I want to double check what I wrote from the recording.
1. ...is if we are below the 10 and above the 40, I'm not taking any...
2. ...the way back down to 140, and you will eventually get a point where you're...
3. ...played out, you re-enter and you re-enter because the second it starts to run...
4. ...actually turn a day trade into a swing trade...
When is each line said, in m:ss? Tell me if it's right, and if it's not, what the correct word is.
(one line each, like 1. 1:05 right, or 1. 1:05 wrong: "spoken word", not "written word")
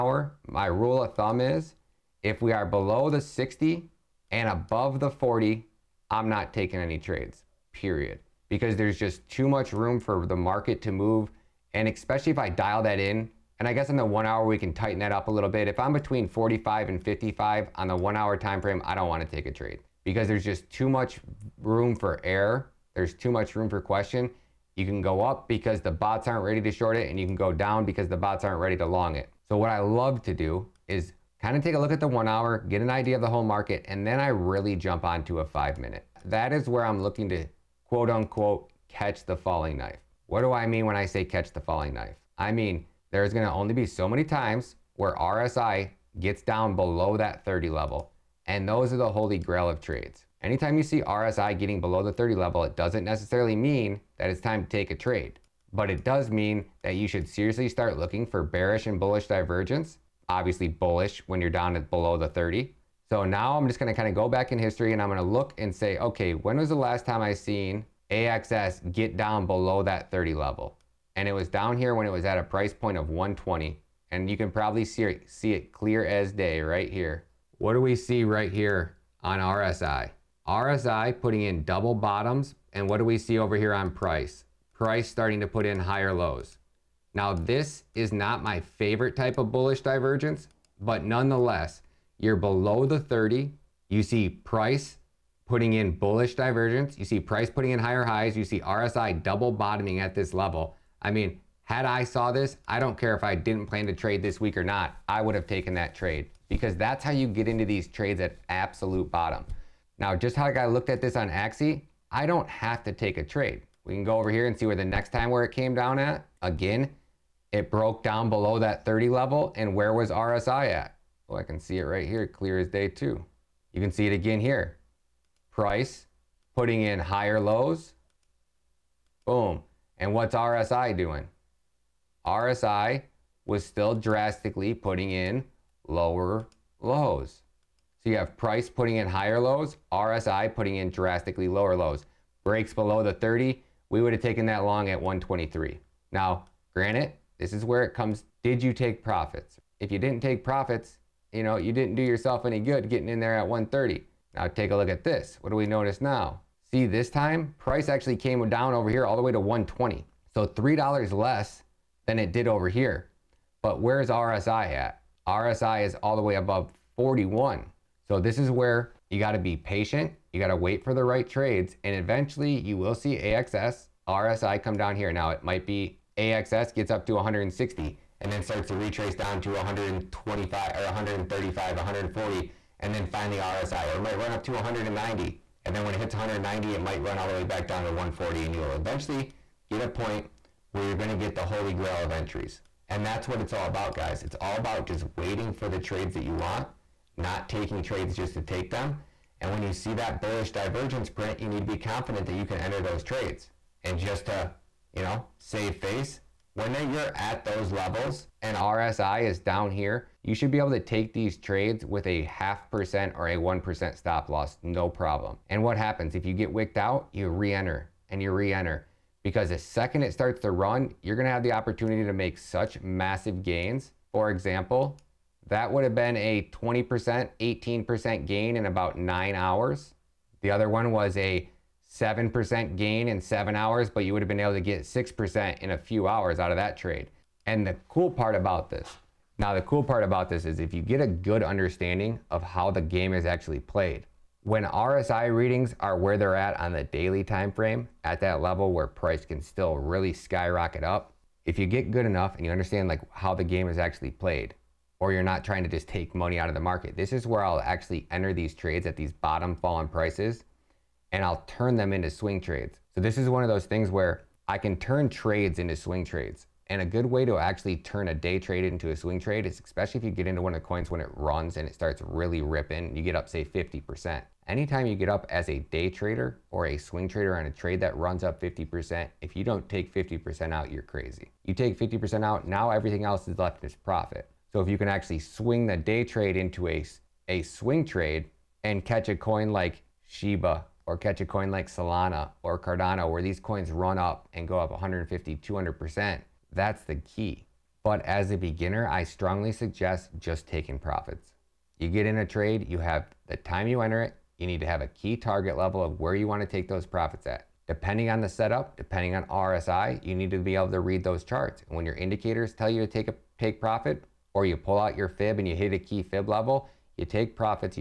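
1. 0:01 wrong: "60", not "10"
2. 3:07 right
3. 3:36 wrong: "wicked", not "played"
4. 4:27 right.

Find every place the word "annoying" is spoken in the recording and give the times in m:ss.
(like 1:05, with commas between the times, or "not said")
not said.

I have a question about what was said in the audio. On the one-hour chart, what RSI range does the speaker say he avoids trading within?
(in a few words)
45 and 55.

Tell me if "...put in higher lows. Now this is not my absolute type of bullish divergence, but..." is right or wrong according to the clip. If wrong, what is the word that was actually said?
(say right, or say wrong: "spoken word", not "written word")
wrong: "favorite", not "absolute".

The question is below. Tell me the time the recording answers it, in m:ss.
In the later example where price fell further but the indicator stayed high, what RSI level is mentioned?
2:46.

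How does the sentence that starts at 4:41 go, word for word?
You take 50% out, now everything else is left as profit.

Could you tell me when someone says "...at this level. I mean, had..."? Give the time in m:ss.
1:39.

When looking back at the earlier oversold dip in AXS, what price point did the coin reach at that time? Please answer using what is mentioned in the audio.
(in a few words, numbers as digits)
120.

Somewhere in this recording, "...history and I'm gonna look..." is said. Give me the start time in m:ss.
1:04.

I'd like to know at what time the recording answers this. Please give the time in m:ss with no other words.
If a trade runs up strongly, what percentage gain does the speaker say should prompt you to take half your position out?
4:33.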